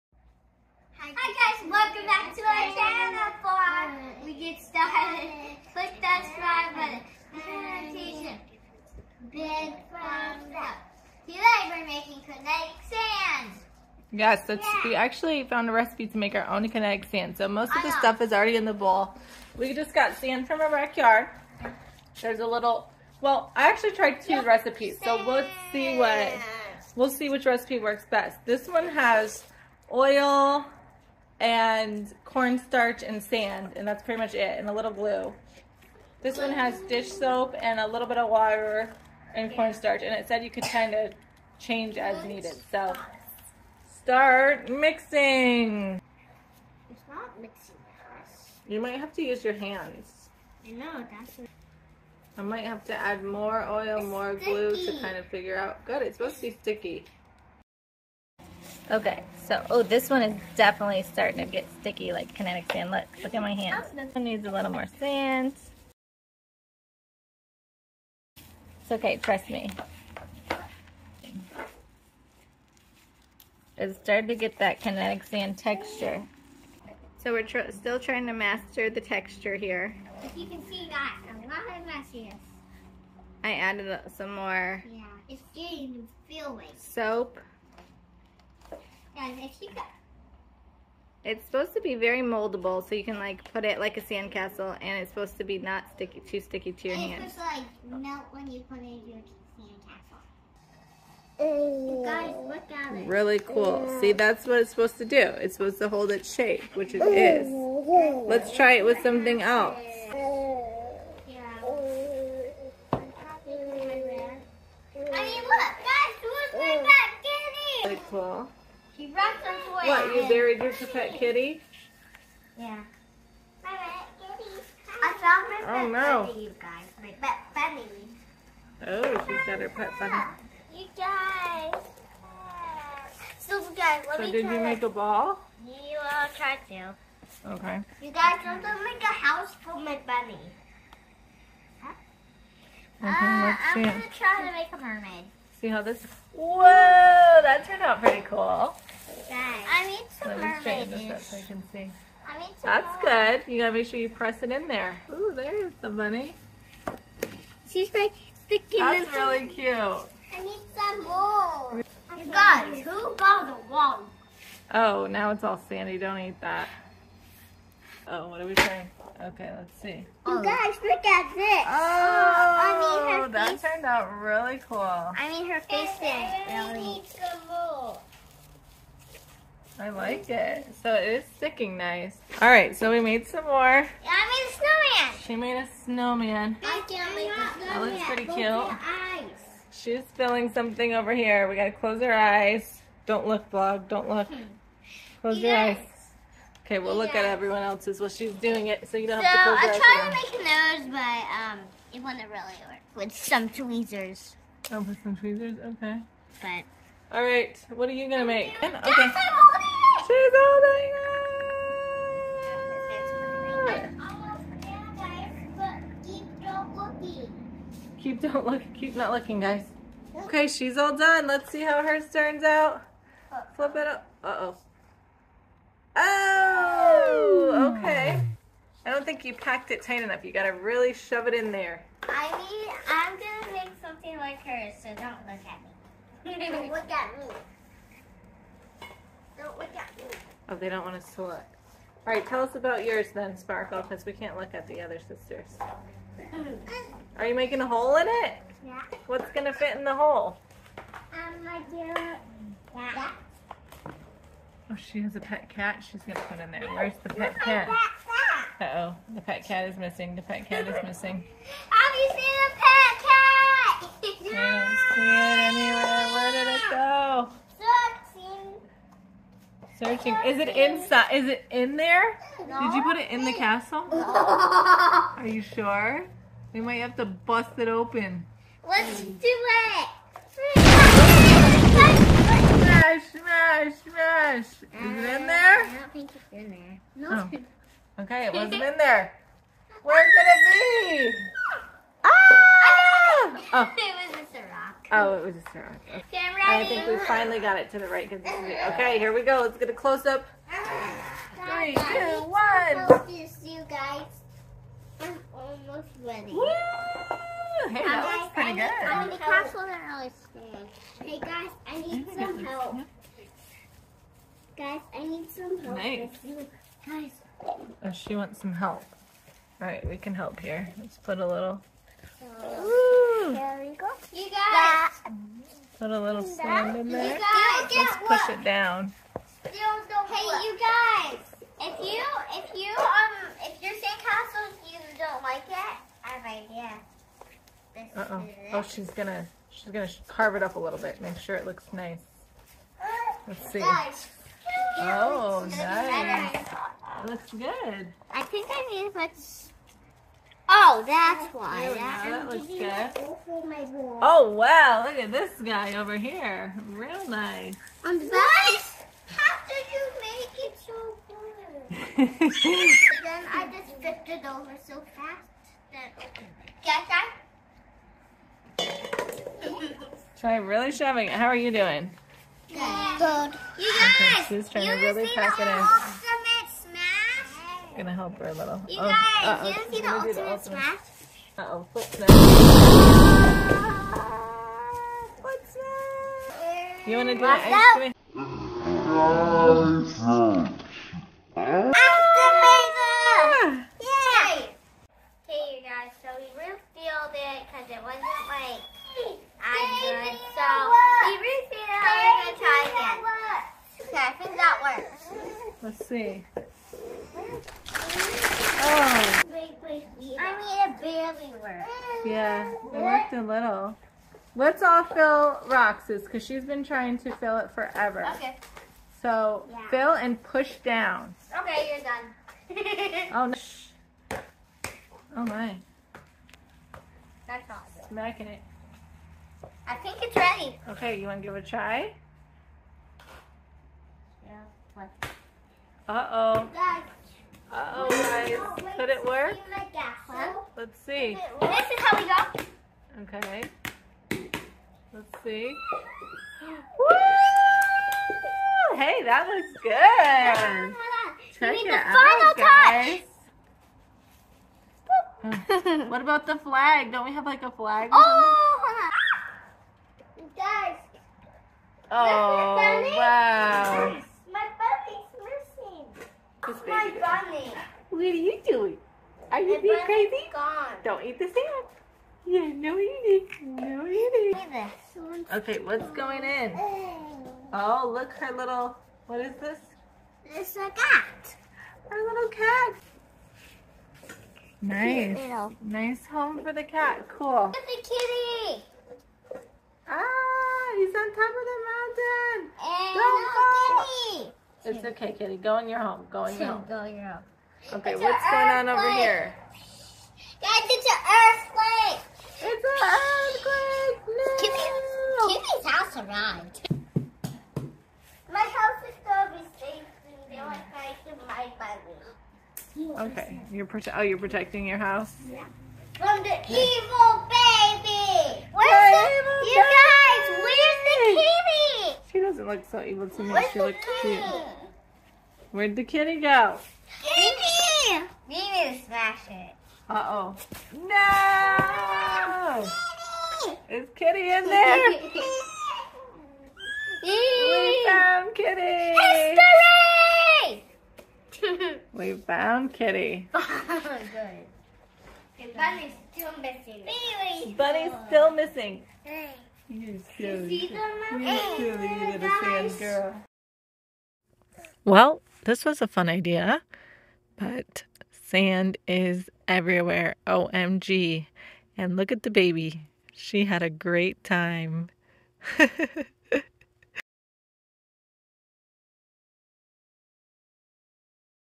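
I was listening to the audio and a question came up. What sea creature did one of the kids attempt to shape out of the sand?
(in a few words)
A mermaid.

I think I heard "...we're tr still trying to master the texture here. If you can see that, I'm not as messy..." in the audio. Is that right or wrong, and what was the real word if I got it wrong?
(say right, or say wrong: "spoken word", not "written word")
right.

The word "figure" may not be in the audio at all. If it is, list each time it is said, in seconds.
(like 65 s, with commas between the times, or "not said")
55 s.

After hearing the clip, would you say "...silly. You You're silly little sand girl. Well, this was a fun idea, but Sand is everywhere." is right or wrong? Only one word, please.
right.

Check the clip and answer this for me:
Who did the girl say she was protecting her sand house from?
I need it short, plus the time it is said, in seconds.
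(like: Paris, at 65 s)
The evil baby, at 516 s.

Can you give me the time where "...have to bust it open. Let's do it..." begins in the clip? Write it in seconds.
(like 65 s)
276 s.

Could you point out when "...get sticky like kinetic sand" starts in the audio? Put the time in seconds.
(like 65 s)
61 s.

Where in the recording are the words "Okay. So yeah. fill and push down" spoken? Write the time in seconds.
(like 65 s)
418 s.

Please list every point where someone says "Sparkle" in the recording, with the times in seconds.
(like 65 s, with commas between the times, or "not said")
243 s.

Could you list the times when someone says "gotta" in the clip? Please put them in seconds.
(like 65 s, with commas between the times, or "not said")
153 s, 191 s, 230 s.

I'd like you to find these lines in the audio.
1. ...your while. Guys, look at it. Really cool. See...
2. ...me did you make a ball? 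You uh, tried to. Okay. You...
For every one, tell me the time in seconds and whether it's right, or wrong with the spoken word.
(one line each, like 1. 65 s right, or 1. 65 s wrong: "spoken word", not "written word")
1. 99 s wrong: "sandcastle", not "while"
2. 134 s right.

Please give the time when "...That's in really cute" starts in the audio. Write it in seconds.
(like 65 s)
158 s.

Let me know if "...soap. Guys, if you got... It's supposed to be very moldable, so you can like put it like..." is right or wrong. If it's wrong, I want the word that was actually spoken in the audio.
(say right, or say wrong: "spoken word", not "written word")
right.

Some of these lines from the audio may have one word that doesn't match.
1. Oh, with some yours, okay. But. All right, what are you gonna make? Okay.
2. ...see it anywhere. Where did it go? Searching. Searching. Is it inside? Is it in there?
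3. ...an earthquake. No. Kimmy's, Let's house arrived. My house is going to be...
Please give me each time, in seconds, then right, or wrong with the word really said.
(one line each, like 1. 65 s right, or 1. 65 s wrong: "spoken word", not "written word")
1. 204 s wrong: "tweezers", not "yours"
2. 264 s right
3. 502 s wrong: "Kimmy", not "Let".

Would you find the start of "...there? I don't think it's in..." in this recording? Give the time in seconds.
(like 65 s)
285 s.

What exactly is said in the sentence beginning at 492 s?
And Don't no, It's okay, kitty.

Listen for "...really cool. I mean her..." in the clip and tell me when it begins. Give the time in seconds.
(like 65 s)
174 s.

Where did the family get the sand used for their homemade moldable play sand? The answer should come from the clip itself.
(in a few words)
Backyard.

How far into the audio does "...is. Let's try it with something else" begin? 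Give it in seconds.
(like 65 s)
107 s.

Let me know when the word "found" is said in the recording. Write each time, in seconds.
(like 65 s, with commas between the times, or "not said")
15 s, 125 s, 537 s, 542 s.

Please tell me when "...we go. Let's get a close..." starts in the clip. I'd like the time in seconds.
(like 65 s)
299 s.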